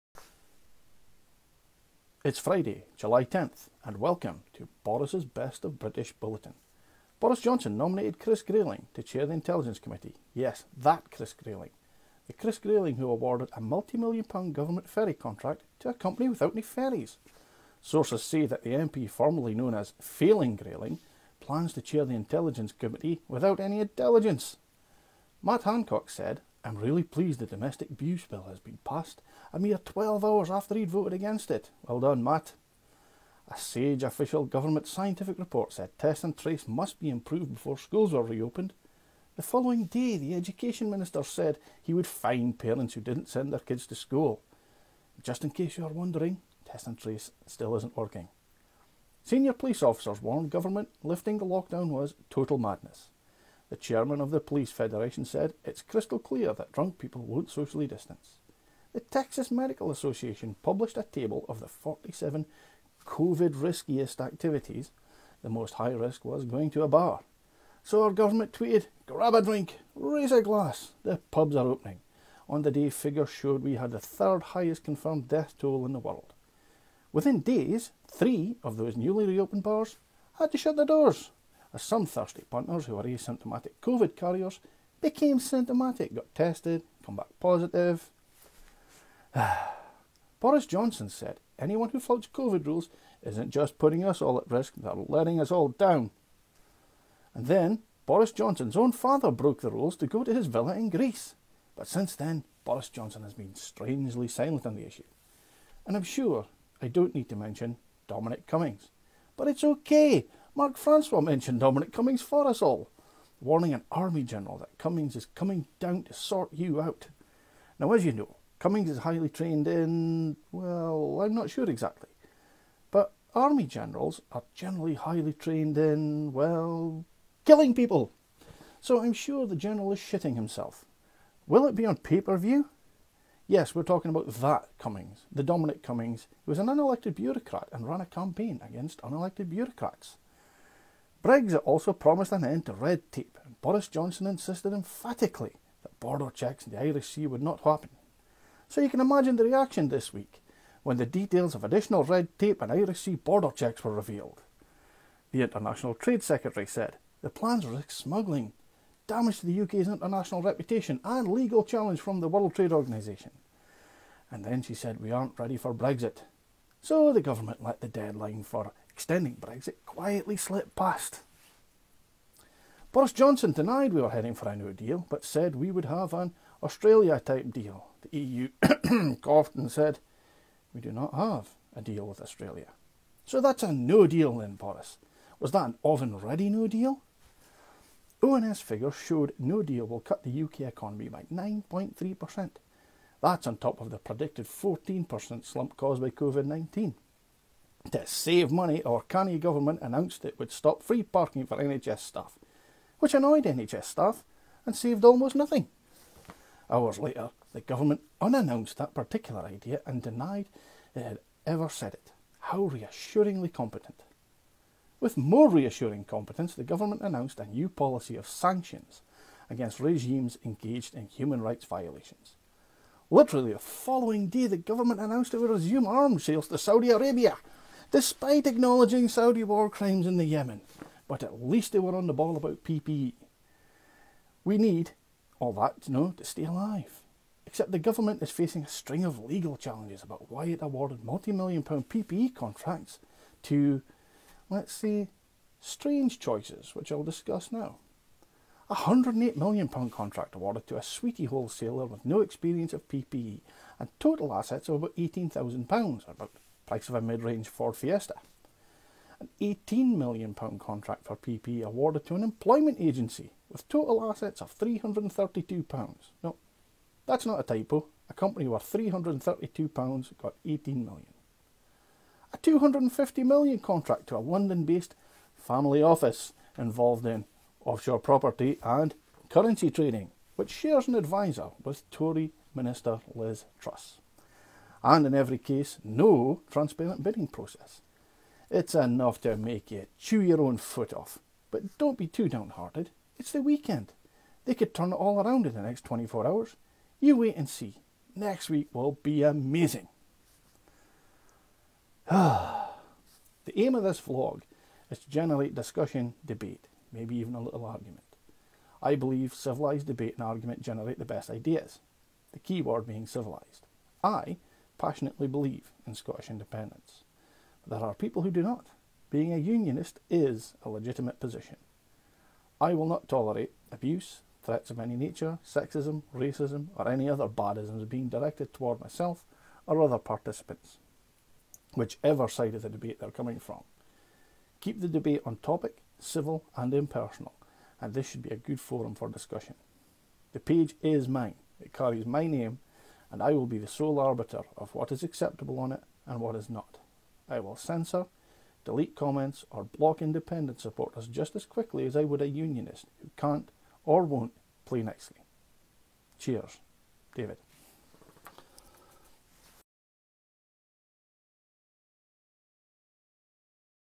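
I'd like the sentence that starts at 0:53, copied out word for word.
The chairman of the Police Federation said it's crystal clear that drunk people won't socially distance.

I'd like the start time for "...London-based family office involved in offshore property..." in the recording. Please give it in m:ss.
4:34.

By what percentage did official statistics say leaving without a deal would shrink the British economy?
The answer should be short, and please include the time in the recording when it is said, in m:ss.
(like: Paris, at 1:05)
9.3%, at 3:11.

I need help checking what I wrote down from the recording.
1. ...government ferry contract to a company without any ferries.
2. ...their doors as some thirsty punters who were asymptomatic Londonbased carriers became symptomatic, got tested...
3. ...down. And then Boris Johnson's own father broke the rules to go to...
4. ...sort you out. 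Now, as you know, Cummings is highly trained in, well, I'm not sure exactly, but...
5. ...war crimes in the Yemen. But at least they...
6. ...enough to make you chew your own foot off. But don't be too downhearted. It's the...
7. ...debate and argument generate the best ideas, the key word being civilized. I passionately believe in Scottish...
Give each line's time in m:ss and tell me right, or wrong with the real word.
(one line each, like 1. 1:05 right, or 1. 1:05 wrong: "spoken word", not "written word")
1. 0:14 right
2. 1:20 wrong: "COVID", not "Londonbased"
3. 1:35 right
4. 1:56 right
5. 3:49 right
6. 4:48 right
7. 5:09 right.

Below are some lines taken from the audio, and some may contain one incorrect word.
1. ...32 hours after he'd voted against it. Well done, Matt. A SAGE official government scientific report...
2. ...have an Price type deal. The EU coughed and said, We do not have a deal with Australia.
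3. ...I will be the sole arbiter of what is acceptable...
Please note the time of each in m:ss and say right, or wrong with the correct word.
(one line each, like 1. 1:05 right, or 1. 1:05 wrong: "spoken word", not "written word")
1. 0:29 wrong: "12", not "32"
2. 2:55 wrong: "Australia", not "Price"
3. 5:43 right.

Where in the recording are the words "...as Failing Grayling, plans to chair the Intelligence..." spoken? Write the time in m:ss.
0:19.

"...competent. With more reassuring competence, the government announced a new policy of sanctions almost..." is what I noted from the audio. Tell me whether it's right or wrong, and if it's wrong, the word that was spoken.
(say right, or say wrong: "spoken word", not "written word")
wrong: "against", not "almost".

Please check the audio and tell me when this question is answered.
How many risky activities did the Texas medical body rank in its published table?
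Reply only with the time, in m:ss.
1:01.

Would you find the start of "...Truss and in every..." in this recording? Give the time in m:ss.
4:43.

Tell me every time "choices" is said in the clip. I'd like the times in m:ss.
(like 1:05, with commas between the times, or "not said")
4:06.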